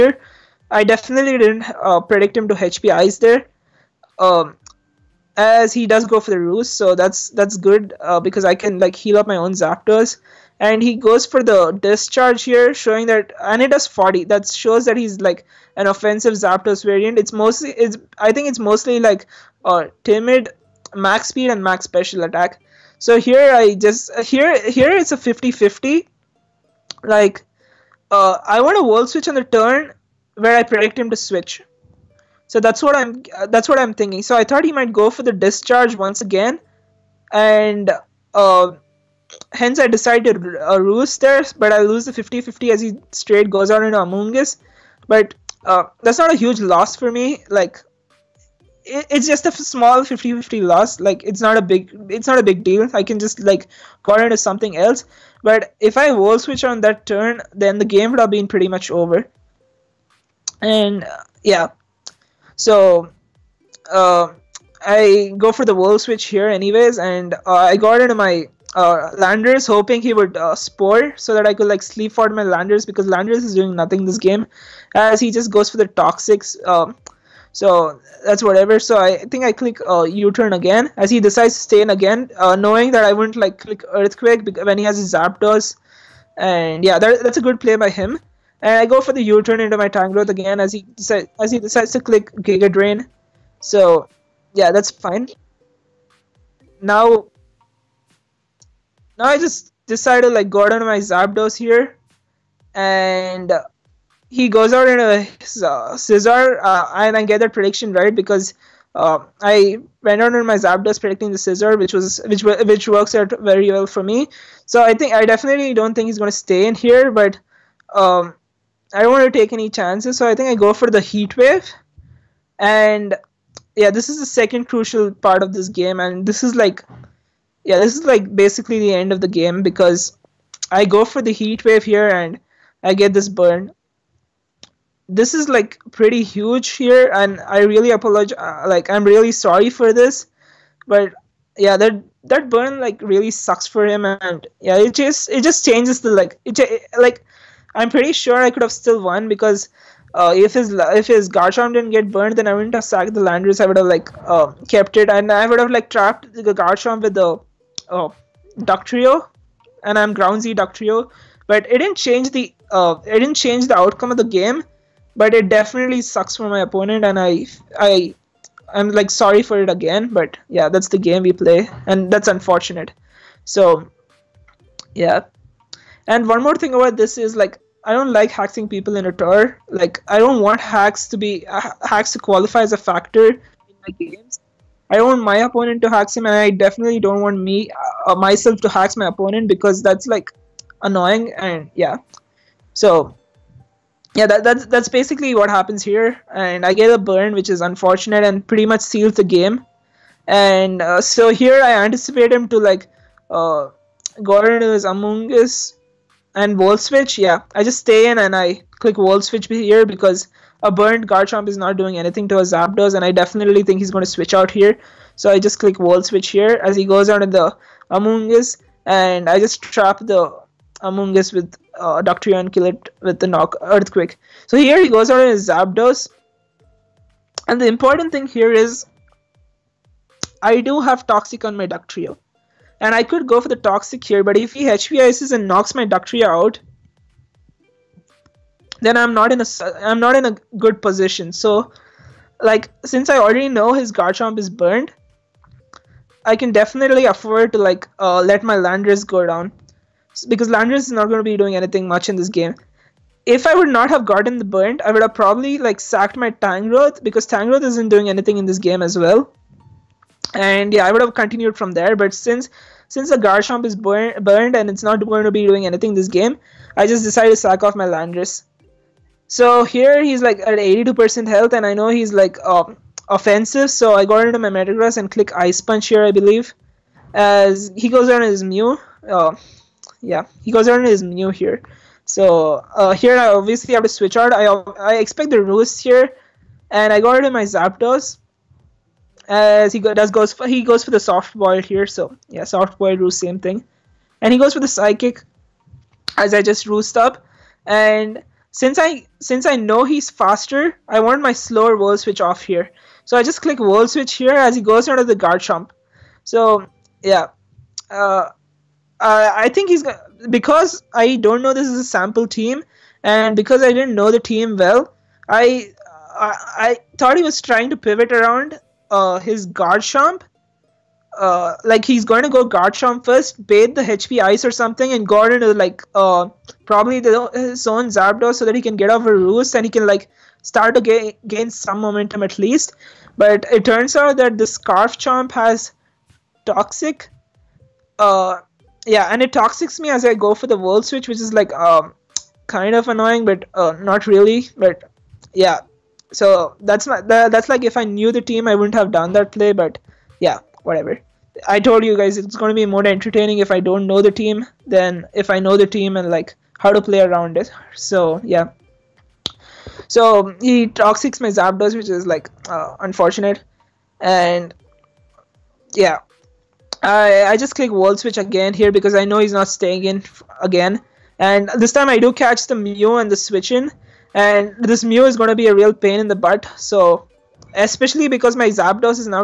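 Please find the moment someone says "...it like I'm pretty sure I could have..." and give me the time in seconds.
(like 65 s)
146 s.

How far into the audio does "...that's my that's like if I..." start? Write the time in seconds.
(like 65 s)
346 s.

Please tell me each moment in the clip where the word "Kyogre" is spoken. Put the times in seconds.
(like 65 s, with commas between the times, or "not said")
not said.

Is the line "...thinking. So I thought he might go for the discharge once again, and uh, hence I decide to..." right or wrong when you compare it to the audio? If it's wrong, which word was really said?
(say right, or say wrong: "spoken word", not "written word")
right.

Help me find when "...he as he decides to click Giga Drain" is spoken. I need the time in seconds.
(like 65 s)
90 s.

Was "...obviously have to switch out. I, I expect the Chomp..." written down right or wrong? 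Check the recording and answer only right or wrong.
wrong.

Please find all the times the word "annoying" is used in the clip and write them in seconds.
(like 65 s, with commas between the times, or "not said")
190 s, 342 s.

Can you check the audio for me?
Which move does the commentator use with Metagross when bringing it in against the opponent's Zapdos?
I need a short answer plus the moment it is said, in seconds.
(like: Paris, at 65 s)
Ice Punch, at 275 s.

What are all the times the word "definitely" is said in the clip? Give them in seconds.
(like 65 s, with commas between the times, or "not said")
0 s, 115 s, 165 s, 186 s, 213 s, 246 s.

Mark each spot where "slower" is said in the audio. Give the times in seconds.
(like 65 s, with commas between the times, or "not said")
301 s.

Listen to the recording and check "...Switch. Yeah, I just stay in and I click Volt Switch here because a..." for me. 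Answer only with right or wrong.
right.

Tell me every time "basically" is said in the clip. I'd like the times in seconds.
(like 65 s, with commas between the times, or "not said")
128 s, 194 s.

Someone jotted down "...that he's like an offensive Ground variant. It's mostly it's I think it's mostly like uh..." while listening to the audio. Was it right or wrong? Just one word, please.
wrong.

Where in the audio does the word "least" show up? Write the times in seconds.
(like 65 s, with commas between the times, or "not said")
332 s.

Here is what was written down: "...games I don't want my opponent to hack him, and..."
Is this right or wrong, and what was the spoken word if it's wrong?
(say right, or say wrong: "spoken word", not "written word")
right.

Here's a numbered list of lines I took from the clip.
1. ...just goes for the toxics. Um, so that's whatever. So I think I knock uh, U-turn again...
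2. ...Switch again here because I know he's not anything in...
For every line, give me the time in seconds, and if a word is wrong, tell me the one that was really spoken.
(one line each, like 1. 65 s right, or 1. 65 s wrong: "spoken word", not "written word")
1. 75 s wrong: "click", not "knock"
2. 367 s wrong: "staying", not "anything".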